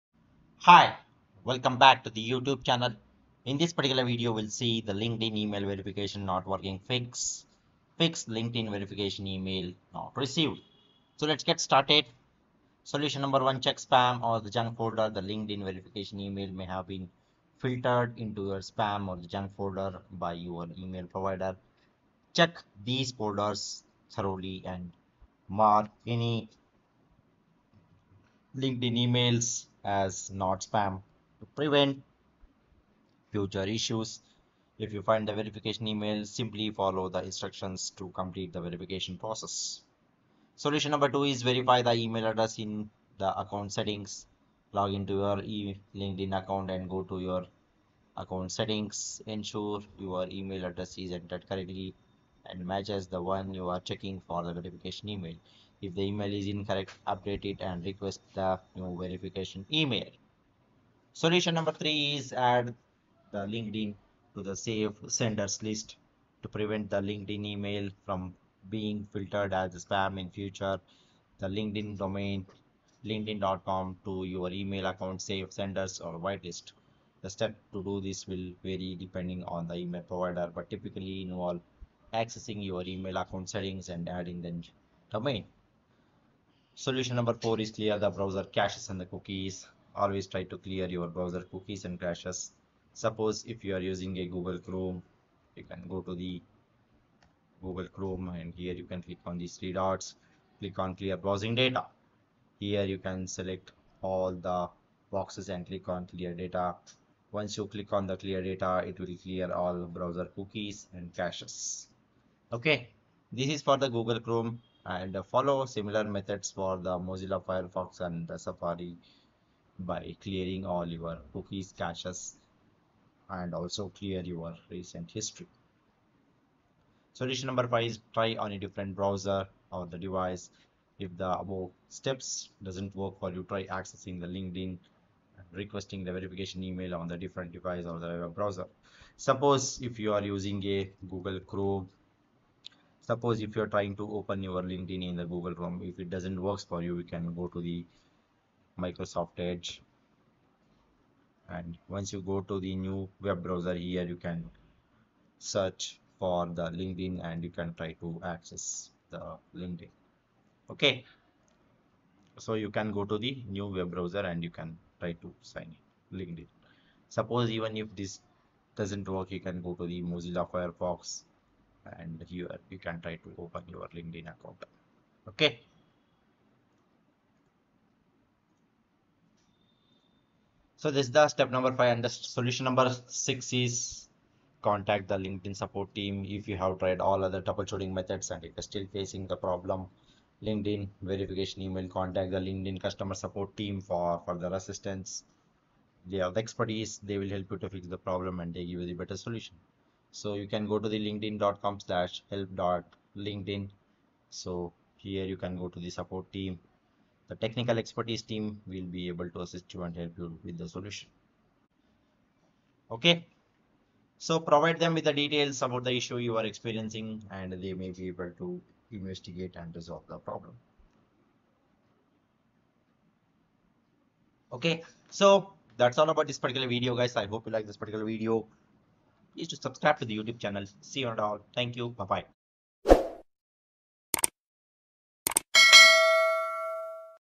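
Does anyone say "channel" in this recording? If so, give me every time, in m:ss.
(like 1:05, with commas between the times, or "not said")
0:02, 3:50.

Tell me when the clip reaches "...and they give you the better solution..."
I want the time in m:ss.
3:18.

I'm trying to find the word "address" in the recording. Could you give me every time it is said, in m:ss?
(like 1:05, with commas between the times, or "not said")
0:42, 0:50.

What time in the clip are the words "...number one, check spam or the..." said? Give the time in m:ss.
0:13.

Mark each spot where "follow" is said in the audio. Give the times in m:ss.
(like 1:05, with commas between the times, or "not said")
0:36, 1:55.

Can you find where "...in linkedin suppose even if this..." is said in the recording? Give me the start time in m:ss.
2:46.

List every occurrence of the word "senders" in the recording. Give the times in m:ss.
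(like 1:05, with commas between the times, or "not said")
1:05, 1:15.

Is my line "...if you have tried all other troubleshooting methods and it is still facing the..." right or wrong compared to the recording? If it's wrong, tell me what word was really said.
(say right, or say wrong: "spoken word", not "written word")
right.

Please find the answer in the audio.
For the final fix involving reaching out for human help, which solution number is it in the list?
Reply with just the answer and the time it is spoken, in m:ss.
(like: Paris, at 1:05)
6, at 3:03.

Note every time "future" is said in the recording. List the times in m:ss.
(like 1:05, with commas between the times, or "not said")
0:33, 1:10.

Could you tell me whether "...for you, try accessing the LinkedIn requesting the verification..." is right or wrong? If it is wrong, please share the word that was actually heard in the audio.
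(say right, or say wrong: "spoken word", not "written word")
right.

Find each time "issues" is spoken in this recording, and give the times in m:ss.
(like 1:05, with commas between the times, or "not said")
0:33, 3:35.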